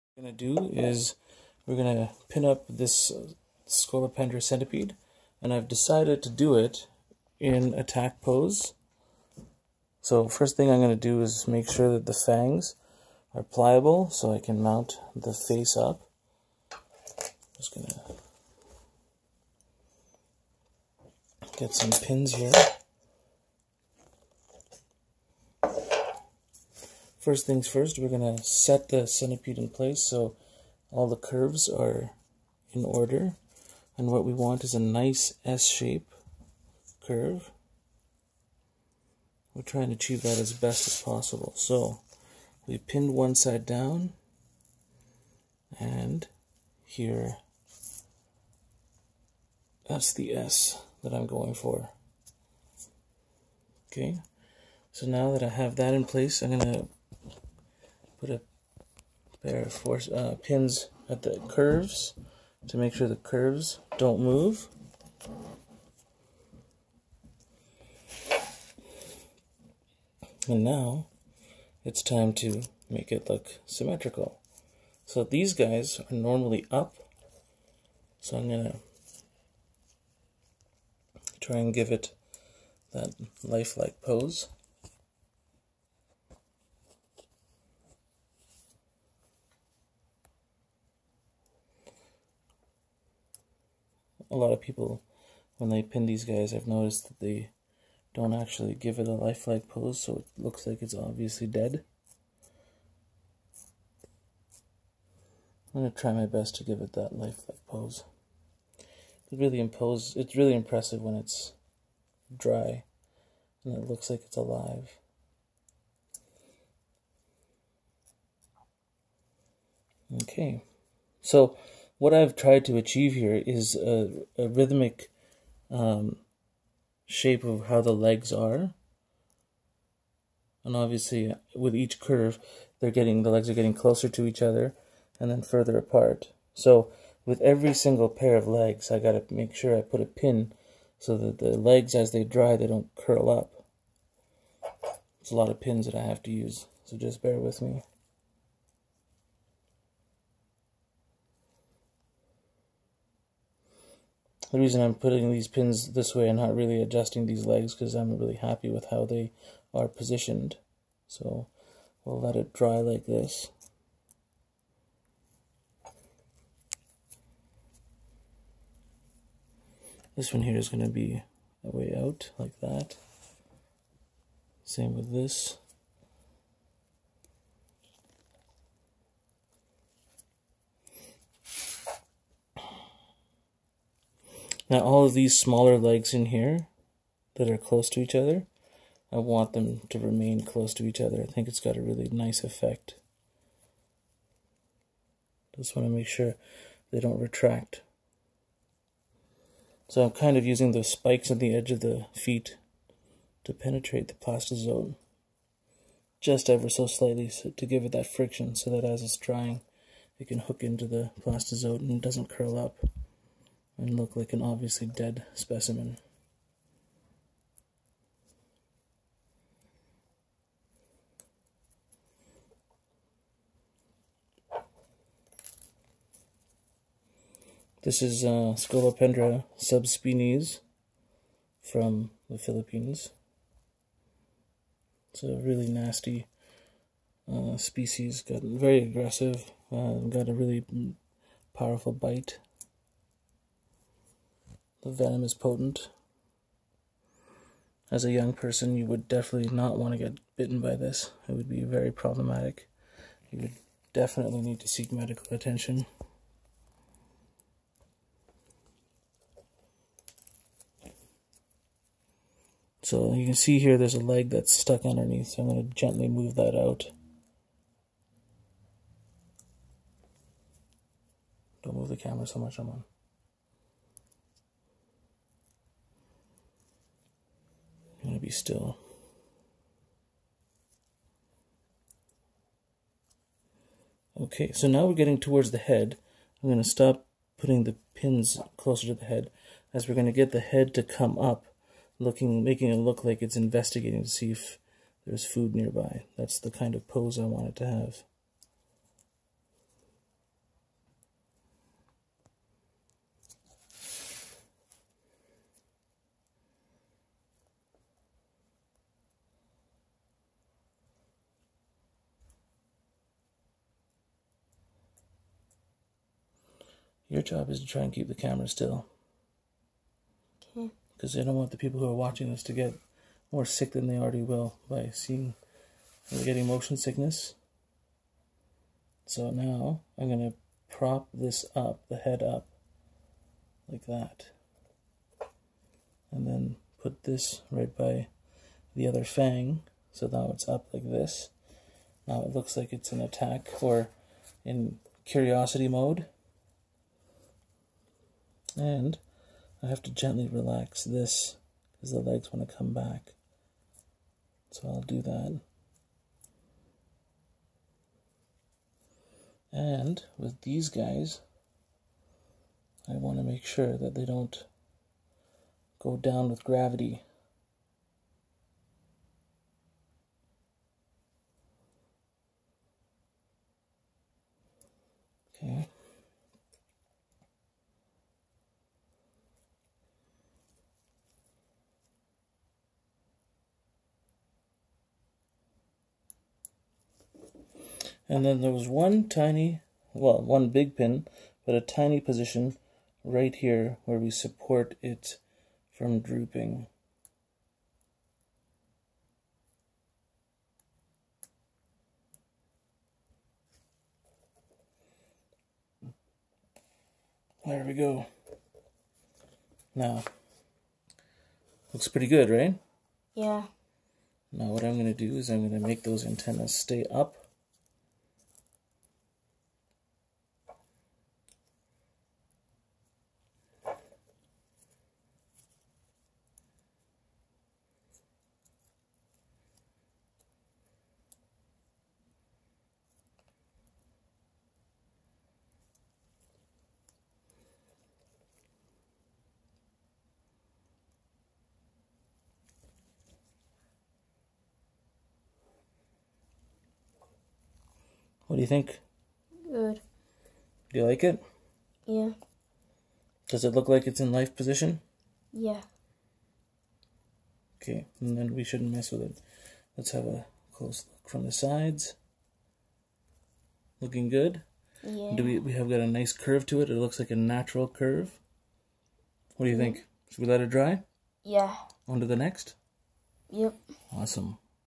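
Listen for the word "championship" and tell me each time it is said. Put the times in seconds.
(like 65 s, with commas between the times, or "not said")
not said.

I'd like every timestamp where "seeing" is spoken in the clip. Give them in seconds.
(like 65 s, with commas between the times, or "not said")
324 s.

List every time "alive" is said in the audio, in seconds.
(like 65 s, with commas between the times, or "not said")
114 s.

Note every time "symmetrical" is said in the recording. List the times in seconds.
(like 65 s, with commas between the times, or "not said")
73 s.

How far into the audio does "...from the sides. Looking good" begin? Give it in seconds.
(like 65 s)
461 s.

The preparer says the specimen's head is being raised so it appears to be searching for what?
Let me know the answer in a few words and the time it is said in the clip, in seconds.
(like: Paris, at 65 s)
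Food, at 295 s.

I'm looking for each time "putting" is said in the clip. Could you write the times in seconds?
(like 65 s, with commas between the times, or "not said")
154 s, 287 s.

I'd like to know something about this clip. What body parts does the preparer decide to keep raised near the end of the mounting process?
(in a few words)
Antennas.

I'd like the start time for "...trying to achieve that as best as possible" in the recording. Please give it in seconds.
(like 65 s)
39 s.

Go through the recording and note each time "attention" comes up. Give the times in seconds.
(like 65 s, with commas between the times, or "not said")
255 s.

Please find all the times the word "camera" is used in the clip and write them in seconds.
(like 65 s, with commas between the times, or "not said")
271 s, 318 s.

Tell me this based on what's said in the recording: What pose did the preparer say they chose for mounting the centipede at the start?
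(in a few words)
Attack pose.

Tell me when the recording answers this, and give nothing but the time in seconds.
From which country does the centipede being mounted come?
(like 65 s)
232 s.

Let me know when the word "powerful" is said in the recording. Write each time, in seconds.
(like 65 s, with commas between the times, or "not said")
241 s.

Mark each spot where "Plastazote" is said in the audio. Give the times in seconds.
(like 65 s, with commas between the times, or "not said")
204 s, 211 s.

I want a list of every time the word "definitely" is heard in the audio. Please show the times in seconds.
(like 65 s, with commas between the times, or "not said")
249 s, 253 s.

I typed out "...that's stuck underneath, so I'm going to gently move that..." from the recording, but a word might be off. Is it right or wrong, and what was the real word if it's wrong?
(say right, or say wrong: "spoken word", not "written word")
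right.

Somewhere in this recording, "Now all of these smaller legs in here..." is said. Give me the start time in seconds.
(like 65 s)
184 s.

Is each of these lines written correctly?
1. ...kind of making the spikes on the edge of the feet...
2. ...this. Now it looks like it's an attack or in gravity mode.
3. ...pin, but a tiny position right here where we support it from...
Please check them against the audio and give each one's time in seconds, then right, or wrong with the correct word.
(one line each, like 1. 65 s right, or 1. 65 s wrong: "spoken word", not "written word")
1. 200 s wrong: "using", not "making"
2. 340 s wrong: "curiosity", not "gravity"
3. 390 s right.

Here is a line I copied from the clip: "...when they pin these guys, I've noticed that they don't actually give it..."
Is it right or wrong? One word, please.
right.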